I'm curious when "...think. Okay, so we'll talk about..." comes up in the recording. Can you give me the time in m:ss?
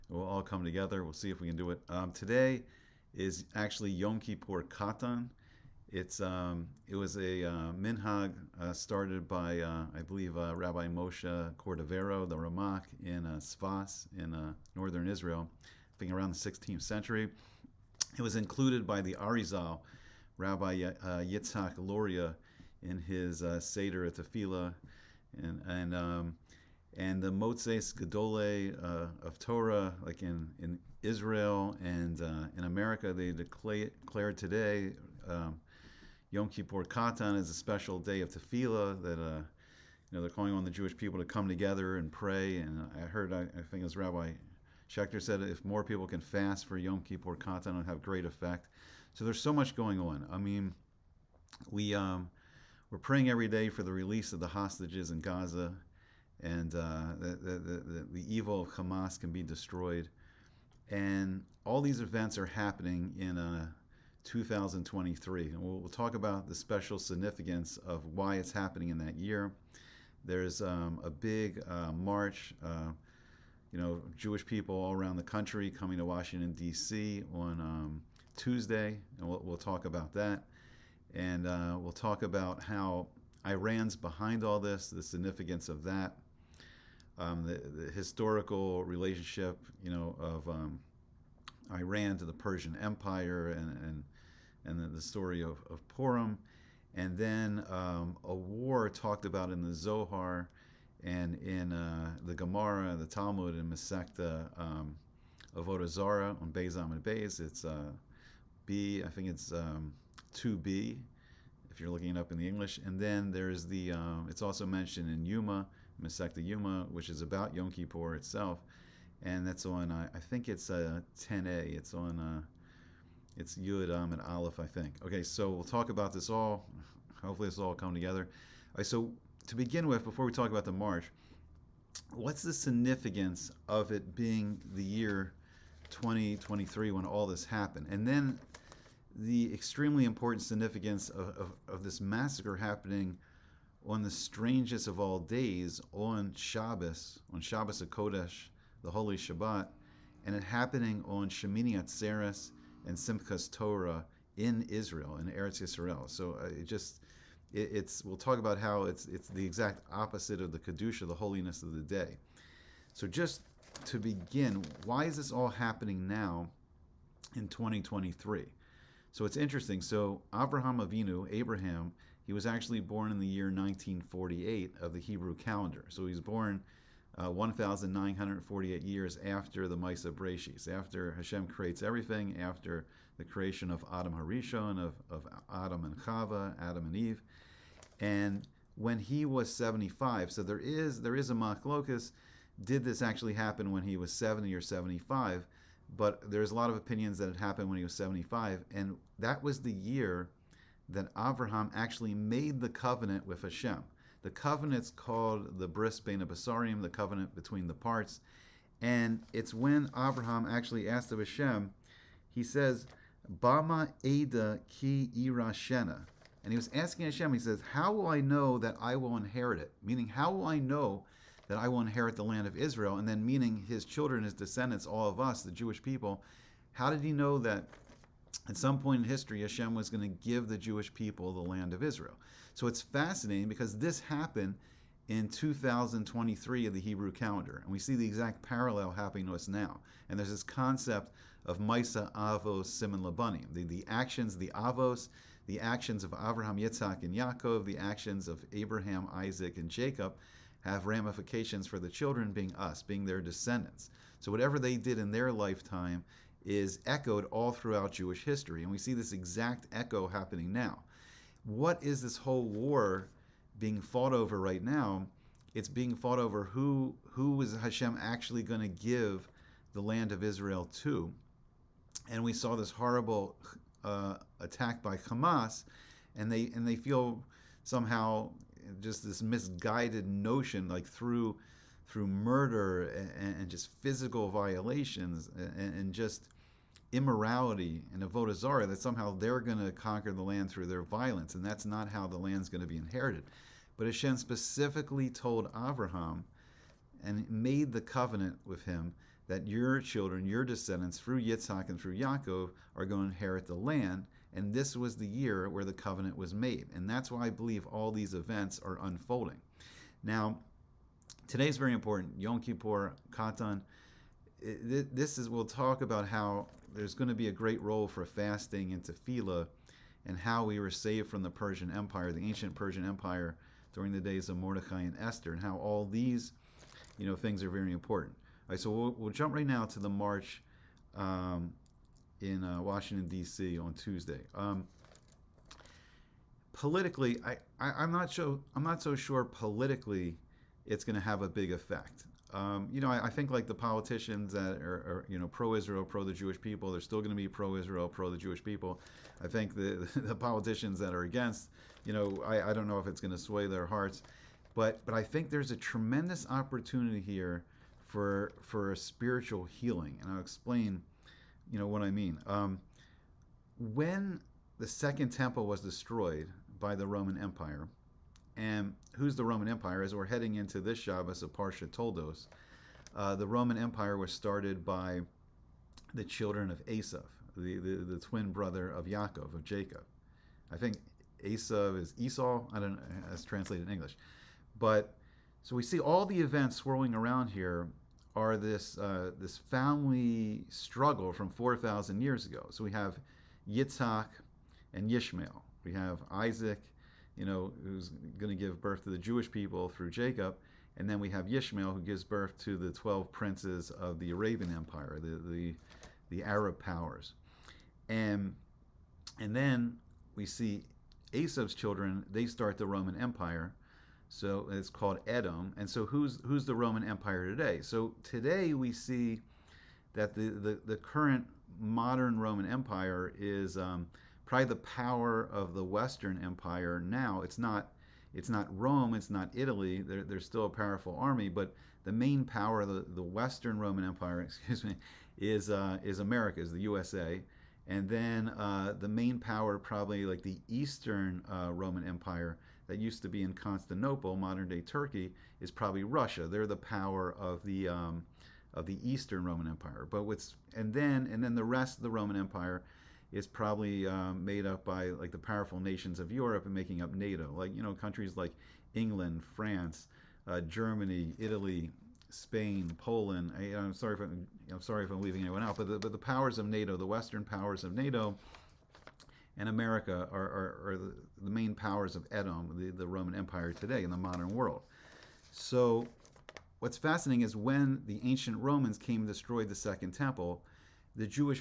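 2:04.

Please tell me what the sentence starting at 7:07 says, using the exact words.
It's not it's not Rome, it's not Italy.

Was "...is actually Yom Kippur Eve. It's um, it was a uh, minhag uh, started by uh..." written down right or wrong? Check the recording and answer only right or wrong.
wrong.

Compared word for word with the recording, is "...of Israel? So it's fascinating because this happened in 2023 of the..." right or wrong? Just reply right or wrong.
right.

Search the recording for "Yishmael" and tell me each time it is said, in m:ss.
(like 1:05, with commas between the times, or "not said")
6:34, 6:41.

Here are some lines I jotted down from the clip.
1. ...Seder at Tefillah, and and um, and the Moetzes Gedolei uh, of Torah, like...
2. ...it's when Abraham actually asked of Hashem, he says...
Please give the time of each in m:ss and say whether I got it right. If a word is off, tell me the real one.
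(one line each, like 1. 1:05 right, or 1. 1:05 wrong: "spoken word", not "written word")
1. 0:23 right
2. 3:29 right.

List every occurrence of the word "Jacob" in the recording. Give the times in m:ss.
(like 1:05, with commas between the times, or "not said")
4:09, 6:19, 6:39.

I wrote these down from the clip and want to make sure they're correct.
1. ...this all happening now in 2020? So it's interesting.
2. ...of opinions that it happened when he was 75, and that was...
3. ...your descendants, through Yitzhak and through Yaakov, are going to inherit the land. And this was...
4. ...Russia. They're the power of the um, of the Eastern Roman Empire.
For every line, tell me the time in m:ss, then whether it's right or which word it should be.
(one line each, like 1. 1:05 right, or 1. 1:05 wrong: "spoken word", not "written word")
1. 2:45 wrong: "2023", not "2020"
2. 3:16 right
3. 5:00 right
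4. 7:25 right.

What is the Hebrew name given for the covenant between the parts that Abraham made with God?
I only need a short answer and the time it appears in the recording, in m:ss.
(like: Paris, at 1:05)
Bris Bena Basarium, at 3:25.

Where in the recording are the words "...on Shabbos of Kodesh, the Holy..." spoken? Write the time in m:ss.
2:27.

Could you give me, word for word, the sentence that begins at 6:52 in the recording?
They start the Roman Empire so it's called Edom.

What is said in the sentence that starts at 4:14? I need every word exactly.
So whatever they did in their lifetime is echoed all throughout Jewish history.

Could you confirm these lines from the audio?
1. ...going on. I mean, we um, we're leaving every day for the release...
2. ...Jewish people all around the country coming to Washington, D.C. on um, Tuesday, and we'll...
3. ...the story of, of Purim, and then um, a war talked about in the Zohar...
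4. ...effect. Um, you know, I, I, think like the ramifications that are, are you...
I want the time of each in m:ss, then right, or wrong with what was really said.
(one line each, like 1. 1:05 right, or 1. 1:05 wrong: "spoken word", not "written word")
1. 0:49 wrong: "praying", not "leaving"
2. 1:14 right
3. 1:34 right
4. 5:41 wrong: "politicians", not "ramifications".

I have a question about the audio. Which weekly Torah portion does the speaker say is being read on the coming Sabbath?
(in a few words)
Toldos.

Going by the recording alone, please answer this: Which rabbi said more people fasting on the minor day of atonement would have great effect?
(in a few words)
Rabbi Schechter.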